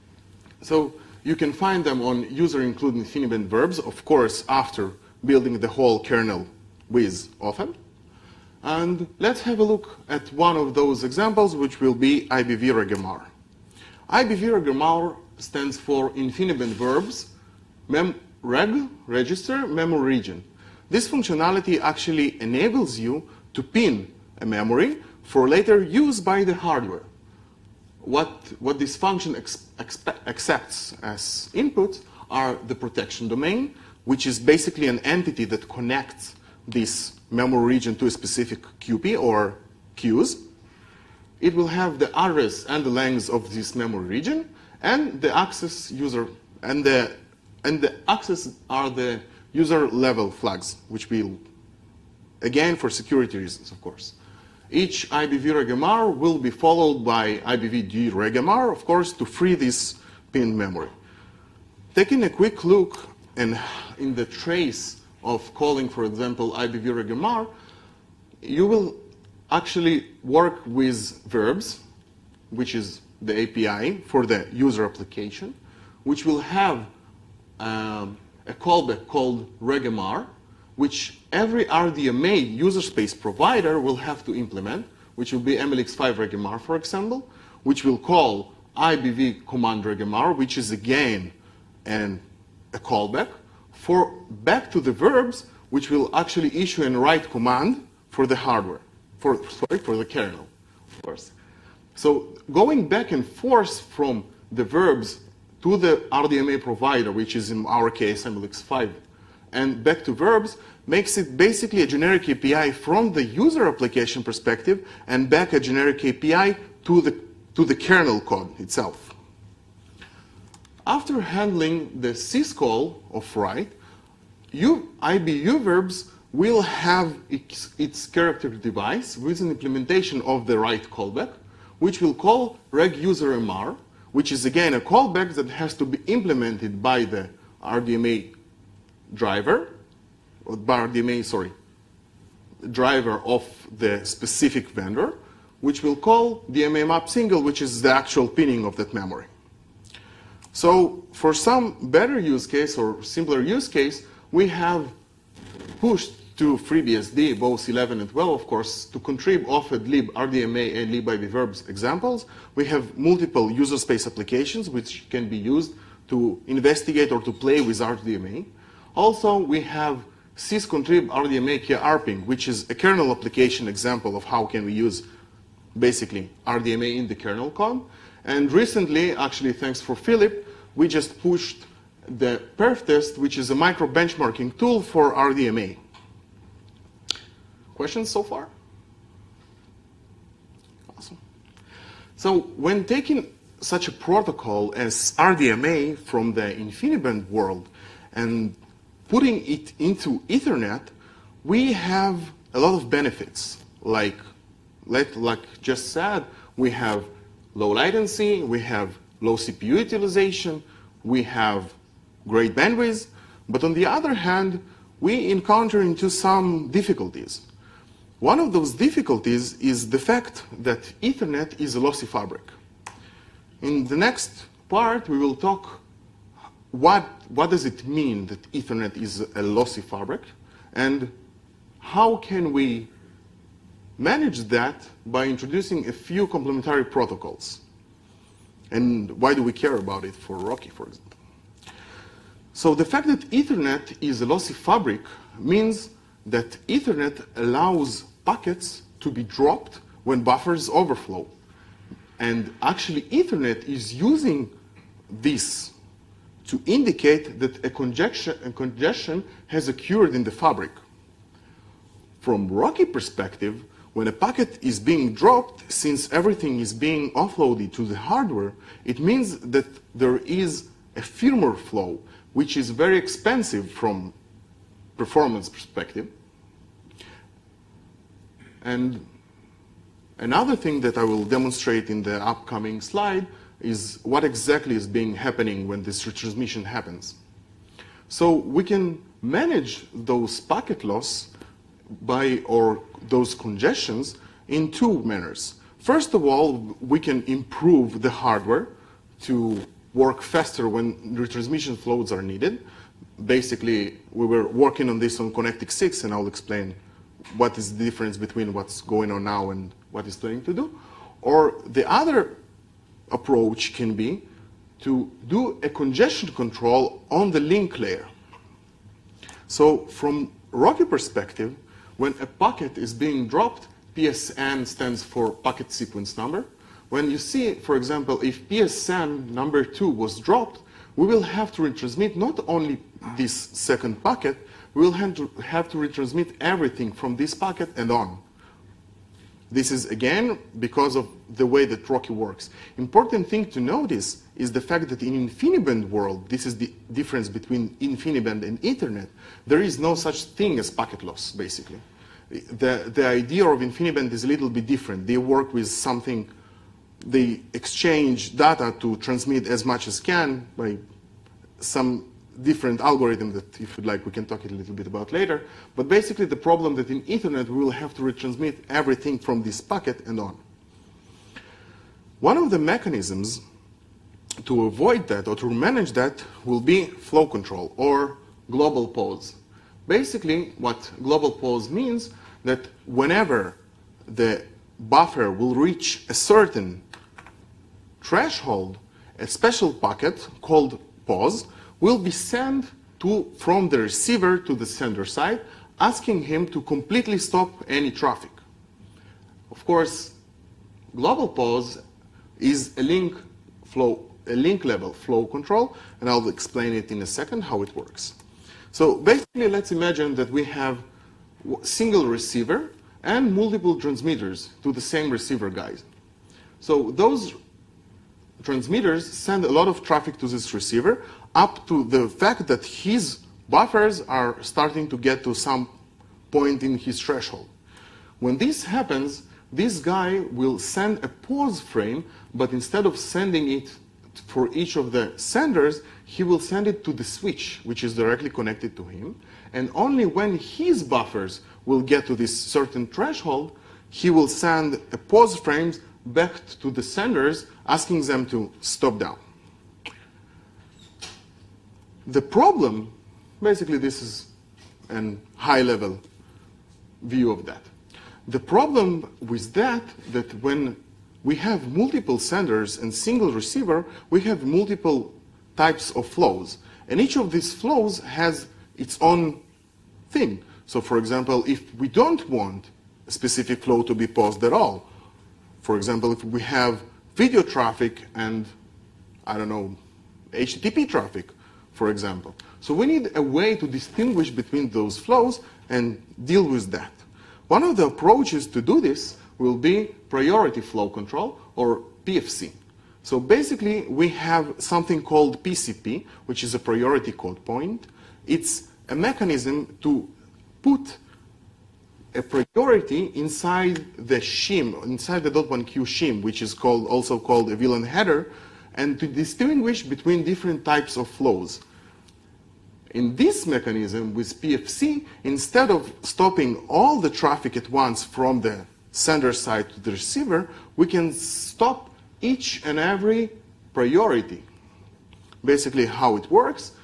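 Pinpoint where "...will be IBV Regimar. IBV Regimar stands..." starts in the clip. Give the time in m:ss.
0:11.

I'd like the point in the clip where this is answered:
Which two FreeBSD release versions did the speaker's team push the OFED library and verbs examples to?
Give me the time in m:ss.
2:37.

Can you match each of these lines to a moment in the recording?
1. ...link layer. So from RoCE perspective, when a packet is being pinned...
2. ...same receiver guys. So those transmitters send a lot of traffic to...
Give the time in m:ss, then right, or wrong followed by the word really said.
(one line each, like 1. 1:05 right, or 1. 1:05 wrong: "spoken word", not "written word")
1. 5:17 wrong: "dropped", not "pinned"
2. 6:54 right.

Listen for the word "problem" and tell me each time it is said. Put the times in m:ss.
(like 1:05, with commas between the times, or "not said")
6:06, 7:32, 7:38.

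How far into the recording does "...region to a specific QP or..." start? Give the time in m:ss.
0:37.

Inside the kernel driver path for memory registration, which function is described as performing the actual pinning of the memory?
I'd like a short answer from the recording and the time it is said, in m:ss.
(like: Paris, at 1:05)
DMA map single, at 2:26.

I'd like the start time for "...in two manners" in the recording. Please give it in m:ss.
4:54.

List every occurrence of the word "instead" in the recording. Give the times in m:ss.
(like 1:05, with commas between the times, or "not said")
7:12, 8:35.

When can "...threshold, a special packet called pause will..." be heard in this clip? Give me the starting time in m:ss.
6:28.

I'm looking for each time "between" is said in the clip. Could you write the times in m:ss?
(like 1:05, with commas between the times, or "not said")
5:08, 5:47, 8:04, 8:29.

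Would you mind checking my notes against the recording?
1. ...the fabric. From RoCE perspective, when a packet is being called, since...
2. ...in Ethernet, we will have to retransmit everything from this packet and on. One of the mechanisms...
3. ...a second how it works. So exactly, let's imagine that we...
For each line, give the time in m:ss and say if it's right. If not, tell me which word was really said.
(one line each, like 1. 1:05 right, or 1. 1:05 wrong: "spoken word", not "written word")
1. 4:20 wrong: "dropped", not "called"
2. 6:06 right
3. 6:47 wrong: "basically", not "exactly".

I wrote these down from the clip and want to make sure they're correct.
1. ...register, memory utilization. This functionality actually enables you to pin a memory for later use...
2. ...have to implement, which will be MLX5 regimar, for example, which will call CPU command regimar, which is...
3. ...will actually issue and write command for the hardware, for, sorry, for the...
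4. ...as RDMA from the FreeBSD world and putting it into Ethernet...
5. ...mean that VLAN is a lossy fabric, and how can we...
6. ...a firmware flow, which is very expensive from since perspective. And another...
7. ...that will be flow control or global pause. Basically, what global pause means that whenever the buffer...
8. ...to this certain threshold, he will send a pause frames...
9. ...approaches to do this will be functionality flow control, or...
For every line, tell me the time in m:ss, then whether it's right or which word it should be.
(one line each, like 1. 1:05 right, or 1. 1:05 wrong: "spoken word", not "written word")
1. 0:19 wrong: "region", not "utilization"
2. 1:23 wrong: "IBV", not "CPU"
3. 1:35 right
4. 3:14 wrong: "InfiniBand", not "FreeBSD"
5. 3:47 wrong: "Ethernet", not "VLAN"
6. 4:30 wrong: "performance", not "since"
7. 6:15 right
8. 7:22 right
9. 8:07 wrong: "priority", not "functionality".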